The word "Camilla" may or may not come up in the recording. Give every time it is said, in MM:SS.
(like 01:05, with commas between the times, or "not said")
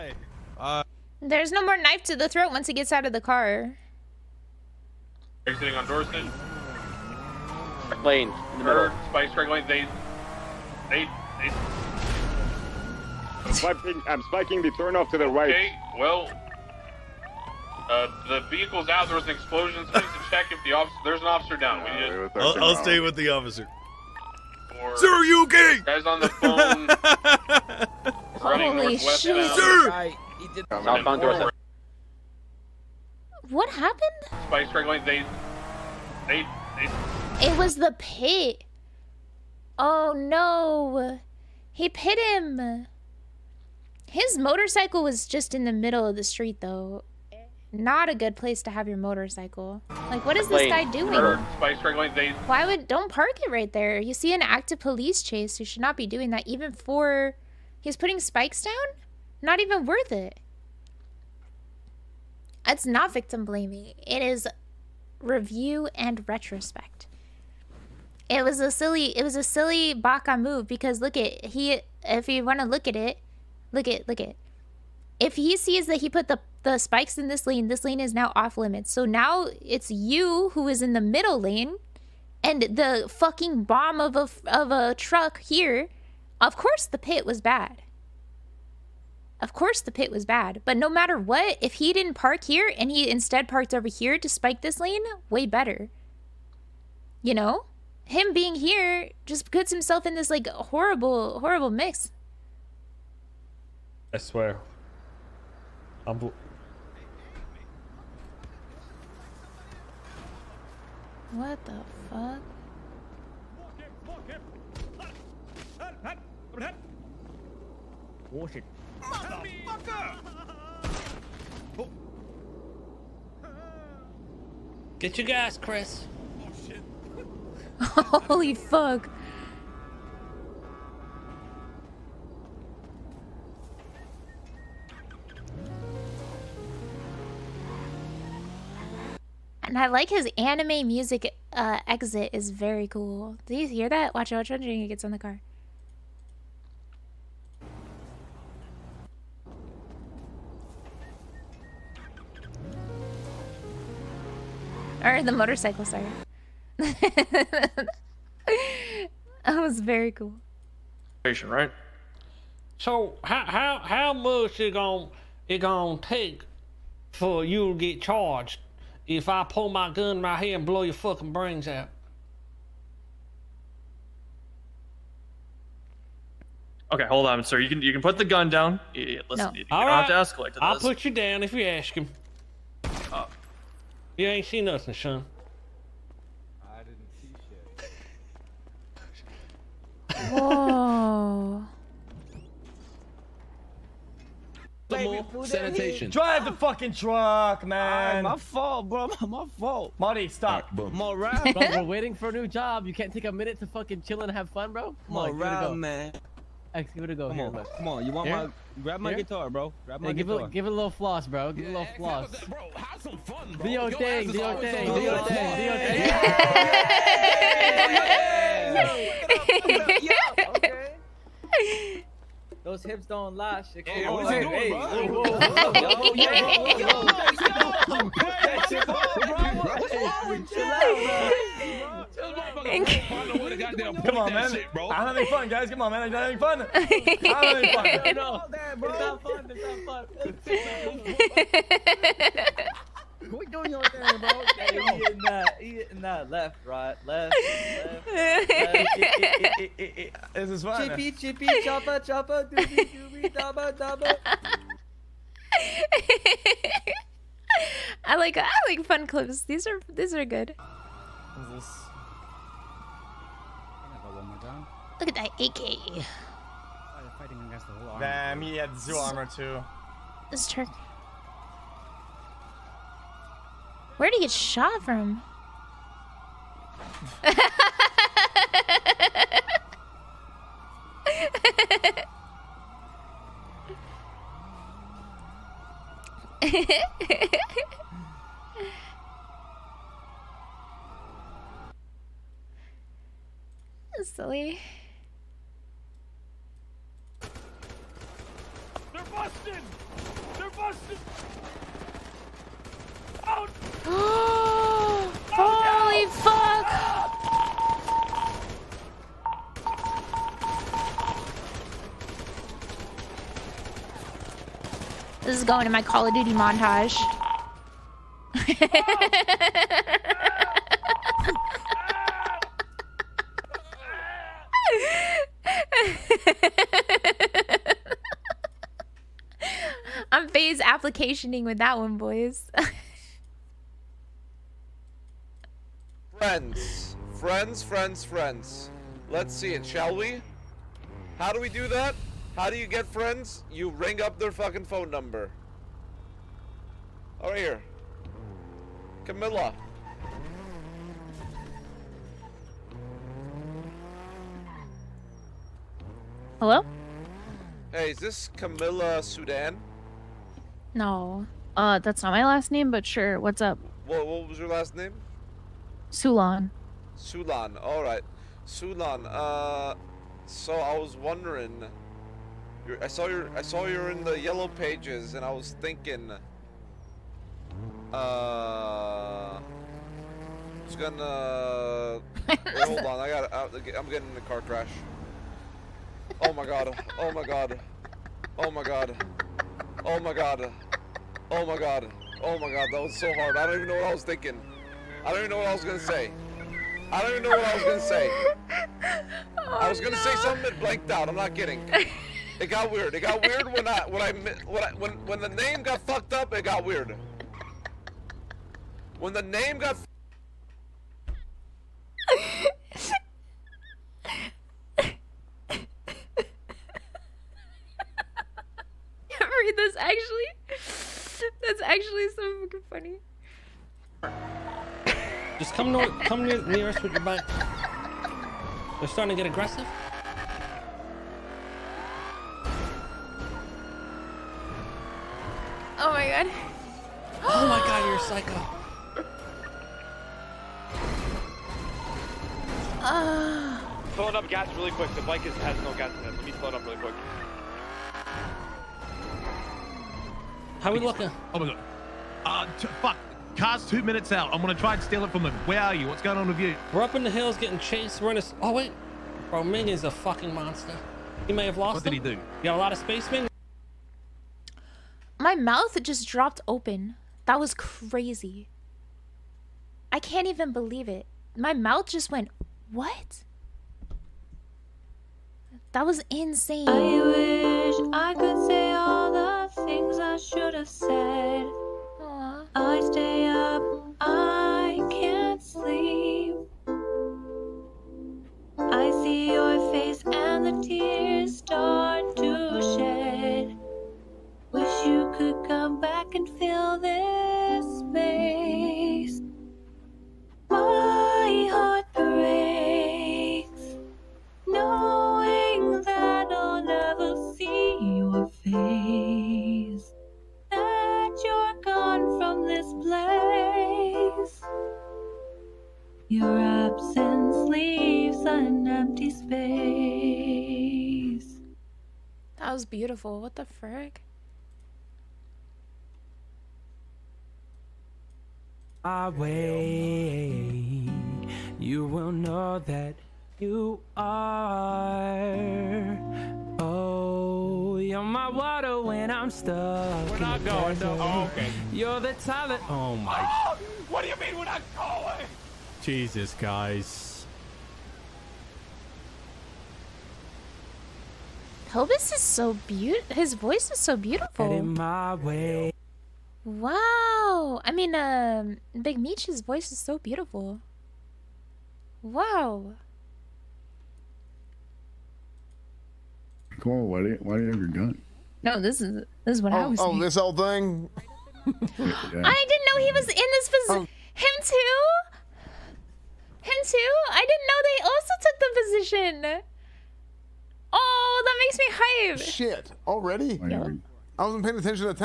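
05:49, 05:58.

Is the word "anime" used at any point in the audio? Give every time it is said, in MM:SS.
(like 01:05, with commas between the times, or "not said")
02:20.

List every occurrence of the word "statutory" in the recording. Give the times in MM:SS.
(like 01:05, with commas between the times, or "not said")
not said.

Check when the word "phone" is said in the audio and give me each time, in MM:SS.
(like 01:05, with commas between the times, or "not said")
00:26, 05:44.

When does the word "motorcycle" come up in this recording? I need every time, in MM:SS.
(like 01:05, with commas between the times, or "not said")
00:44, 00:48, 02:35.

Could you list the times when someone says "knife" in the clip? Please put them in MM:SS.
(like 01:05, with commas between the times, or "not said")
00:01.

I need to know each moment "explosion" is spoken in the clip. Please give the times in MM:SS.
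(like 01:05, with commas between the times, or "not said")
00:19.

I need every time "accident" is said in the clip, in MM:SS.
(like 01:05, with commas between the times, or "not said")
not said.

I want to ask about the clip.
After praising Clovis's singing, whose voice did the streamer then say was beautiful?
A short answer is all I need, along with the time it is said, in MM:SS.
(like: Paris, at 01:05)
Big Meech, at 09:18.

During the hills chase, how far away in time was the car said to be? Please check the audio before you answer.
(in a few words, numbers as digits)
2 minutes.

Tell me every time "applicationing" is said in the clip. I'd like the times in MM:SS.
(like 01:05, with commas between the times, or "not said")
05:30.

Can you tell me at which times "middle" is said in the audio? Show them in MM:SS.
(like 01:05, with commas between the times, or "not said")
00:08, 00:45, 01:21.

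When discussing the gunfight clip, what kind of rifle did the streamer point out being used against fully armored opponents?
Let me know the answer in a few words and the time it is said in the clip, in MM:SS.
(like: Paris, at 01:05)
AK, at 04:24.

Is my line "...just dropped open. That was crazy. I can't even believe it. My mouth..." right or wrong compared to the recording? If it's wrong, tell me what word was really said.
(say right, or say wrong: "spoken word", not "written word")
right.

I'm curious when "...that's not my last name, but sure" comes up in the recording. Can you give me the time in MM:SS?
06:01.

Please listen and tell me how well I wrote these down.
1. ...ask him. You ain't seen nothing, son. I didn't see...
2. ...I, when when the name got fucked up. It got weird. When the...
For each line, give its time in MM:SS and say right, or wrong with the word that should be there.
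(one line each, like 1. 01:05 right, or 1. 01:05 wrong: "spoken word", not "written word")
1. 03:01 right
2. 06:44 right.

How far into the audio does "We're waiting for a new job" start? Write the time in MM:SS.
03:21.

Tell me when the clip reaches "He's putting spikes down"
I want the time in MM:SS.
00:57.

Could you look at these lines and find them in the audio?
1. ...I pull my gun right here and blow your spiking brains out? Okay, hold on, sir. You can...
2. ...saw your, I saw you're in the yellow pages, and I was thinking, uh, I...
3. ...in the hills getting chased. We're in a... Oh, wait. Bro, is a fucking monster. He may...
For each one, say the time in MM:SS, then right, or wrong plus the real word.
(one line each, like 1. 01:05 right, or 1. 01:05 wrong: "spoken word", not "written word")
1. 02:49 wrong: "fucking", not "spiking"
2. 06:12 right
3. 07:36 right.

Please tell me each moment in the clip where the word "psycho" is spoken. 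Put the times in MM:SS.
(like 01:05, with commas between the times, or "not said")
07:17.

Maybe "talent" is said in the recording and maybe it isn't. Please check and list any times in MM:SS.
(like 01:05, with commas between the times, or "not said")
09:02.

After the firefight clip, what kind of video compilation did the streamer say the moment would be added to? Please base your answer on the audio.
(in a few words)
Call of Duty montage.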